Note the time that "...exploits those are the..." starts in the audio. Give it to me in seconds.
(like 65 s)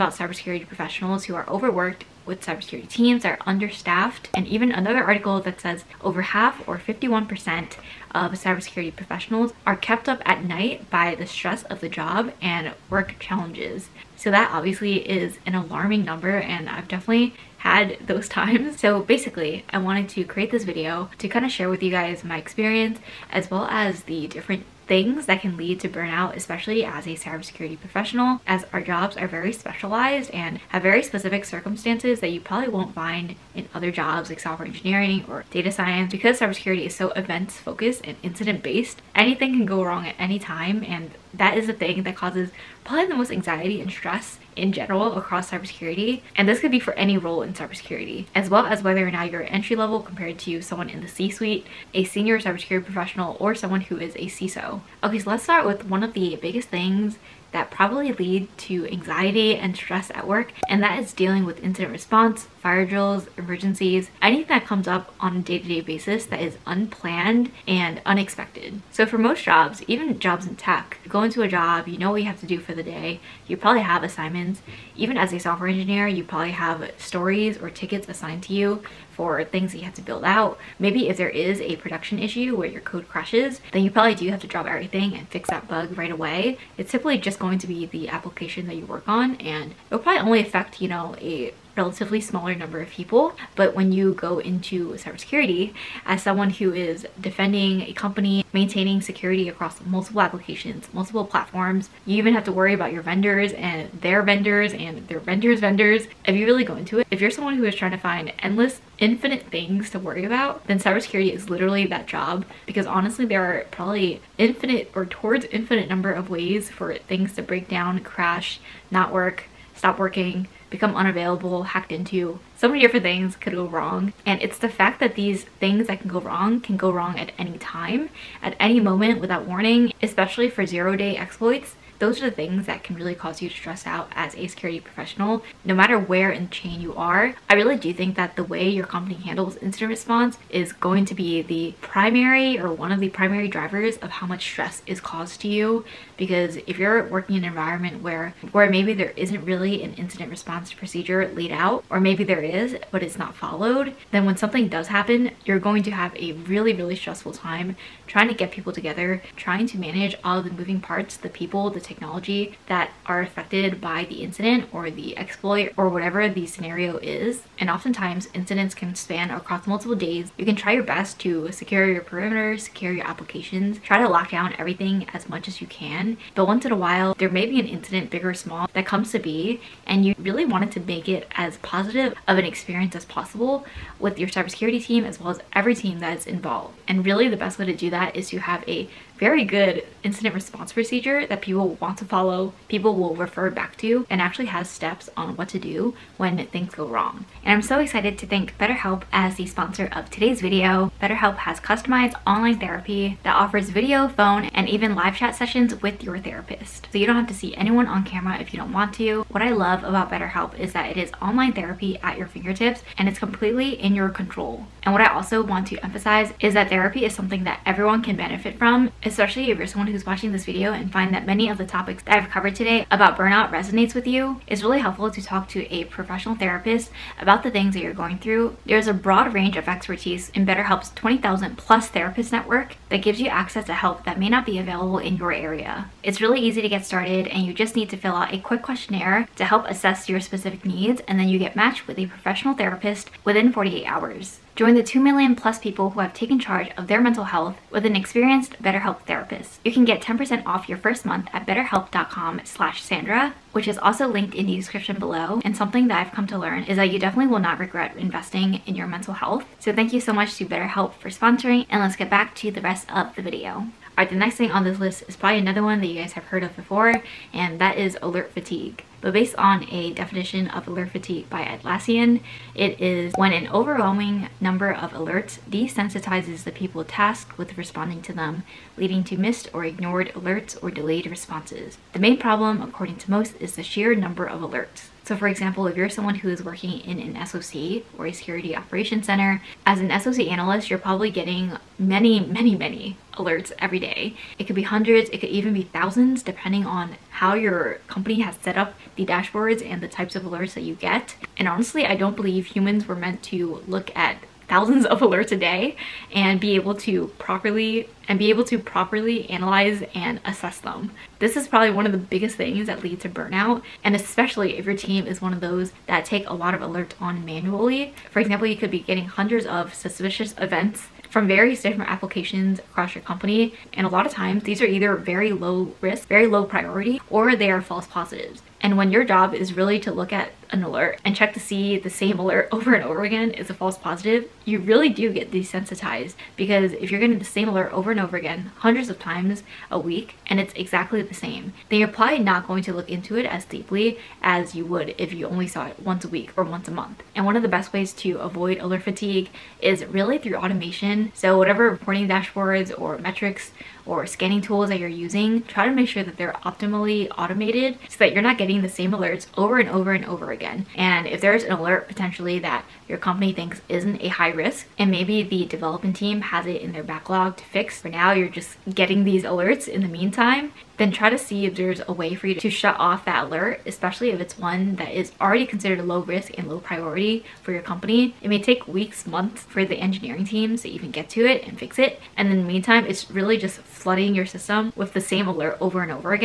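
131 s.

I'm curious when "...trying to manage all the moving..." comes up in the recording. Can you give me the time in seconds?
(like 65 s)
159 s.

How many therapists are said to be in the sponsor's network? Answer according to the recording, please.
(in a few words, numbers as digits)
20,000.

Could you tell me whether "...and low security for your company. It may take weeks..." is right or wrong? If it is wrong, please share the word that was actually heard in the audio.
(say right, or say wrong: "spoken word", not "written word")
wrong: "priority", not "security".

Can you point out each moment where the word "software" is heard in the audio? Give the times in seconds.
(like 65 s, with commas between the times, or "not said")
34 s, 75 s.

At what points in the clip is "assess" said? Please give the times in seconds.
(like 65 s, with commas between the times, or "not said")
239 s, 310 s.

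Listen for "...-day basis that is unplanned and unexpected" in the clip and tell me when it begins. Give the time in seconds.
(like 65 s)
65 s.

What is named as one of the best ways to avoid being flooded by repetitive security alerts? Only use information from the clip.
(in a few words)
automation.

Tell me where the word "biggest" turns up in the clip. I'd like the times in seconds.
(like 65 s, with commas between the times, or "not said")
56 s, 311 s.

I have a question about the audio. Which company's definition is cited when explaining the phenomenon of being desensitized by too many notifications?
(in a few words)
Atlassian.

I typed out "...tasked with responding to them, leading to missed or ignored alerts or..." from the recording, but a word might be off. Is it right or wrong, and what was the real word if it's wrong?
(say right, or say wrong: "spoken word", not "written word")
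right.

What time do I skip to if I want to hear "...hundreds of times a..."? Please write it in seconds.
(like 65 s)
338 s.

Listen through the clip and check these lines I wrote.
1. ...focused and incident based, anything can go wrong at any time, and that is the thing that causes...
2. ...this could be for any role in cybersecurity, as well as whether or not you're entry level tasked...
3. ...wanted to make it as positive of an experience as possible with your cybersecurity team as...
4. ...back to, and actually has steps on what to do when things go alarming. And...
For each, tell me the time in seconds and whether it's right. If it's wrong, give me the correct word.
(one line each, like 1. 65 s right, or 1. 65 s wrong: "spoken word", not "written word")
1. 37 s right
2. 46 s wrong: "compared", not "tasked"
3. 180 s right
4. 193 s wrong: "wrong", not "alarming".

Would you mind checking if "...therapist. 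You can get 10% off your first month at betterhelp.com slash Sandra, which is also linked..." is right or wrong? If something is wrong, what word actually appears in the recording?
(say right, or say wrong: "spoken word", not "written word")
right.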